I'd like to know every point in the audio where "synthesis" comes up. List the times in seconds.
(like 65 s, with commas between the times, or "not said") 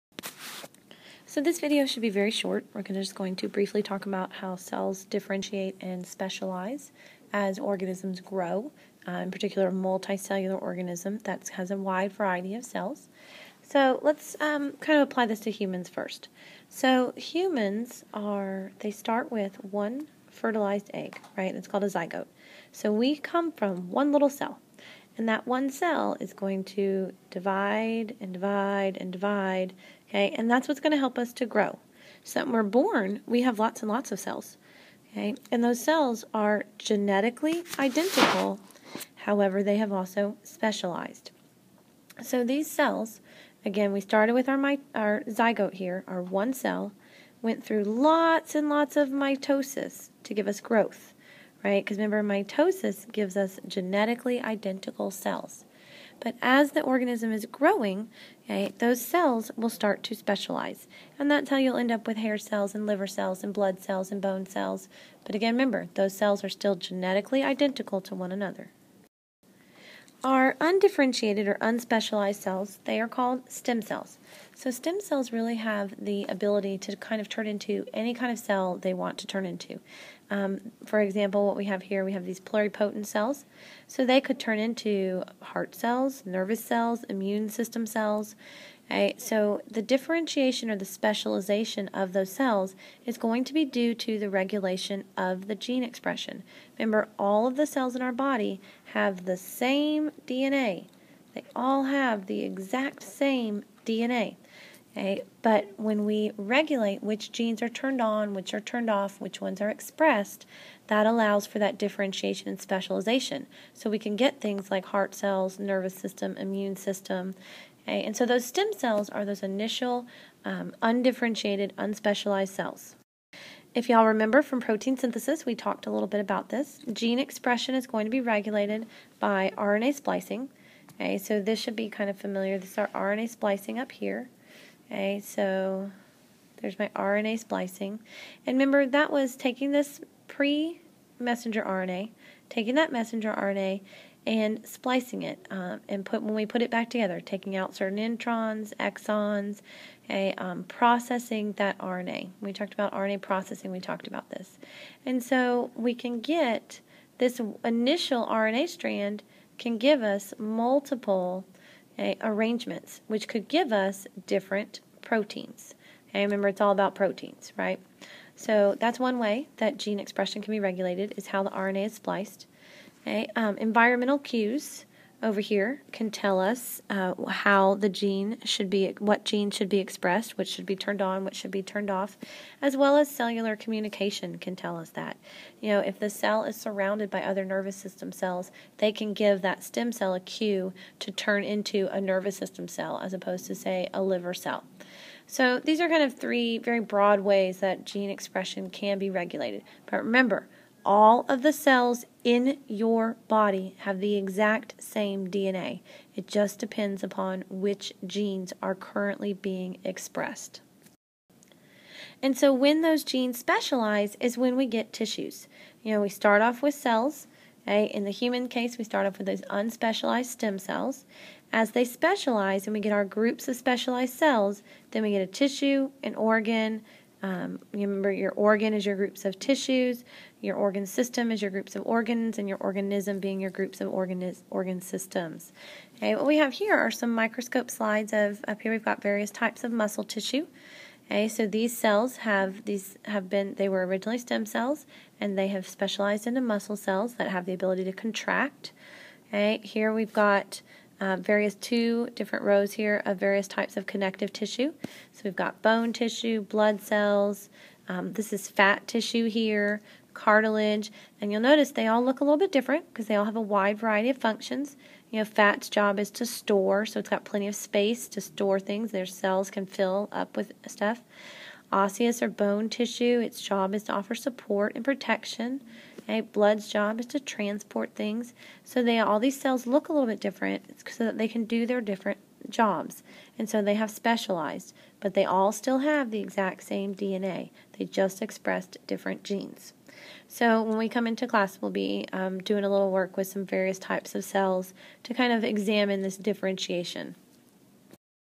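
124 s.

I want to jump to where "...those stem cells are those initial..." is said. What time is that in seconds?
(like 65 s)
118 s.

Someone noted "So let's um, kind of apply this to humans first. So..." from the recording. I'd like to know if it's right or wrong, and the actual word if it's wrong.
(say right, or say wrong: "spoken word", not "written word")
right.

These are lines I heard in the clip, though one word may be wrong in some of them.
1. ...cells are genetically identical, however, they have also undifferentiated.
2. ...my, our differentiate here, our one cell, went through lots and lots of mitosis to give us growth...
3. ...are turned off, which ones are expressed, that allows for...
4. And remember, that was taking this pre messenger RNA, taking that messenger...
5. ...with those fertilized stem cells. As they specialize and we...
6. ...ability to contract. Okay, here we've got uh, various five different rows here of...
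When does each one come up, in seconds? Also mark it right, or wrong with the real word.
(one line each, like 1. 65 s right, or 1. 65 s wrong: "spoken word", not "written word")
1. 35 s wrong: "specialized", not "undifferentiated"
2. 44 s wrong: "zygote", not "differentiate"
3. 108 s right
4. 138 s right
5. 219 s wrong: "unspecialized", not "fertilized"
6. 247 s wrong: "two", not "five".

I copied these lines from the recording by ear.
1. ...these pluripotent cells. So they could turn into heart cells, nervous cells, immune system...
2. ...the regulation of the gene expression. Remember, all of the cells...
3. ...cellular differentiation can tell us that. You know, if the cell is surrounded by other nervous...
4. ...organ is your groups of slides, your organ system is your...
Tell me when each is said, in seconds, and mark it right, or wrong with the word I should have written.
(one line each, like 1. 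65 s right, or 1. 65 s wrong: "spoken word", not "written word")
1. 82 s right
2. 94 s right
3. 183 s wrong: "communication", not "differentiation"
4. 228 s wrong: "tissues", not "slides".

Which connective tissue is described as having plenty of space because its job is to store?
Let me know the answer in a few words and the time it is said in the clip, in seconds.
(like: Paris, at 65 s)
fat tissue, at 258 s.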